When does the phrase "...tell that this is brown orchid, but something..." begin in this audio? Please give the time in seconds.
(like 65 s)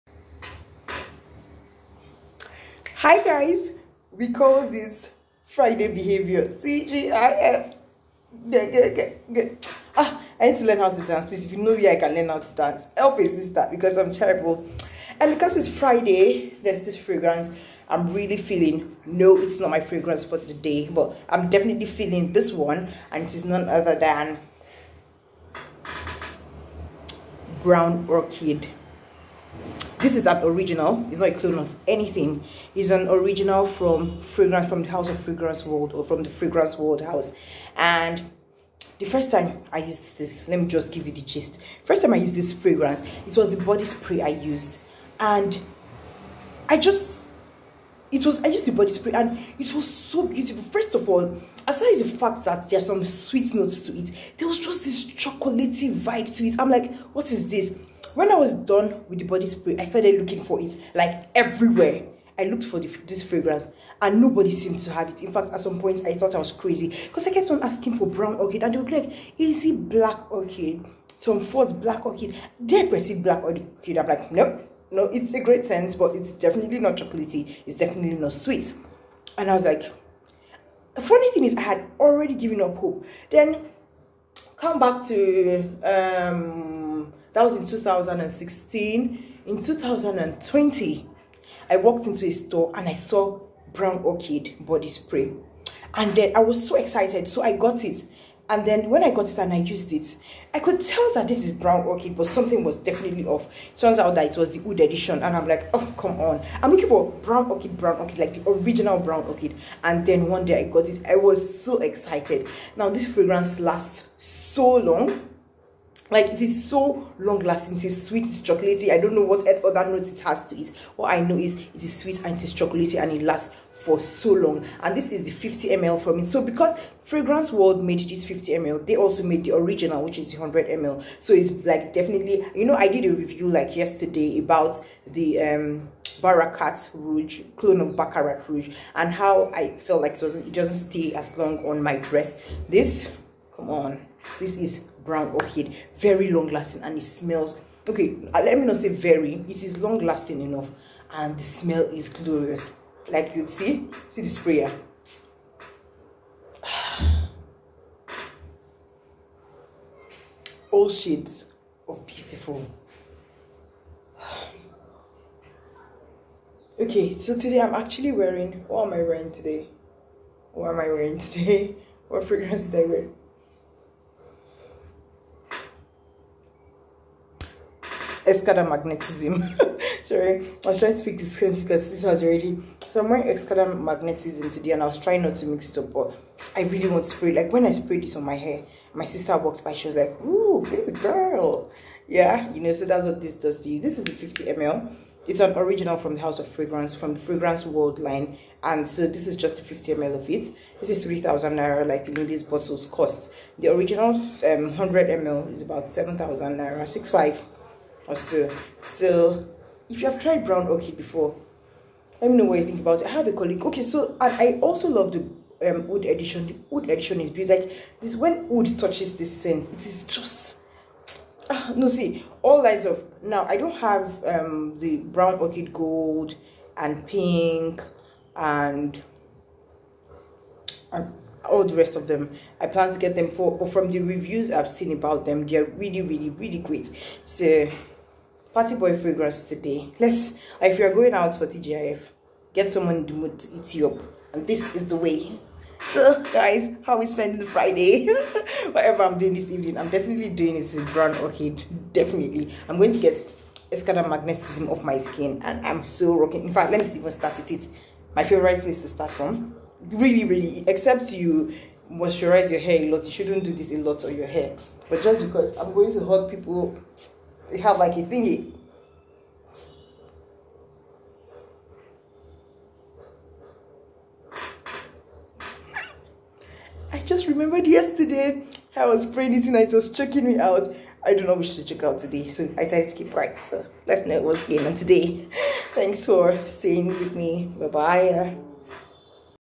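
100 s.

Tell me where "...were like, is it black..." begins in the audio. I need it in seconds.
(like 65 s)
68 s.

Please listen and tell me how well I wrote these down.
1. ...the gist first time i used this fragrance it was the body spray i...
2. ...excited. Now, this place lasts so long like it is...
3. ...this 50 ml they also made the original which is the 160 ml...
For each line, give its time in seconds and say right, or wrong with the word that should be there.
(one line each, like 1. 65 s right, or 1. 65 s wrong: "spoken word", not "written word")
1. 41 s right
2. 111 s wrong: "fragrance", not "place"
3. 128 s wrong: "100", not "160".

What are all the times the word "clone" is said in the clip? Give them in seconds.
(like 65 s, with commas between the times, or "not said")
31 s, 137 s.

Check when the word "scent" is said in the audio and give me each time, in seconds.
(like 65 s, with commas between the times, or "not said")
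75 s, 219 s.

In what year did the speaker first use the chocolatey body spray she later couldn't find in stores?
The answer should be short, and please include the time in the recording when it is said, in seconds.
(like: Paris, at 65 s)
2016, at 87 s.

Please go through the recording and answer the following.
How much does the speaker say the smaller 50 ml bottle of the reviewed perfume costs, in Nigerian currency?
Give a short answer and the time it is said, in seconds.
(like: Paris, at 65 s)
3,000 naira, at 201 s.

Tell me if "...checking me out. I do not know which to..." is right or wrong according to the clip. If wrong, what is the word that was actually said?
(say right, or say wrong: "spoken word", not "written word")
right.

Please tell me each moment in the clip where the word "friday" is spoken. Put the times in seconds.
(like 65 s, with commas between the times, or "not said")
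5 s, 15 s, 247 s.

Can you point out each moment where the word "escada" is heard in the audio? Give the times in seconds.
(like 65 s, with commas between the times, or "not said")
178 s, 183 s, 253 s.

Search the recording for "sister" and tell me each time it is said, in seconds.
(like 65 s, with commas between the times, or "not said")
13 s, 189 s.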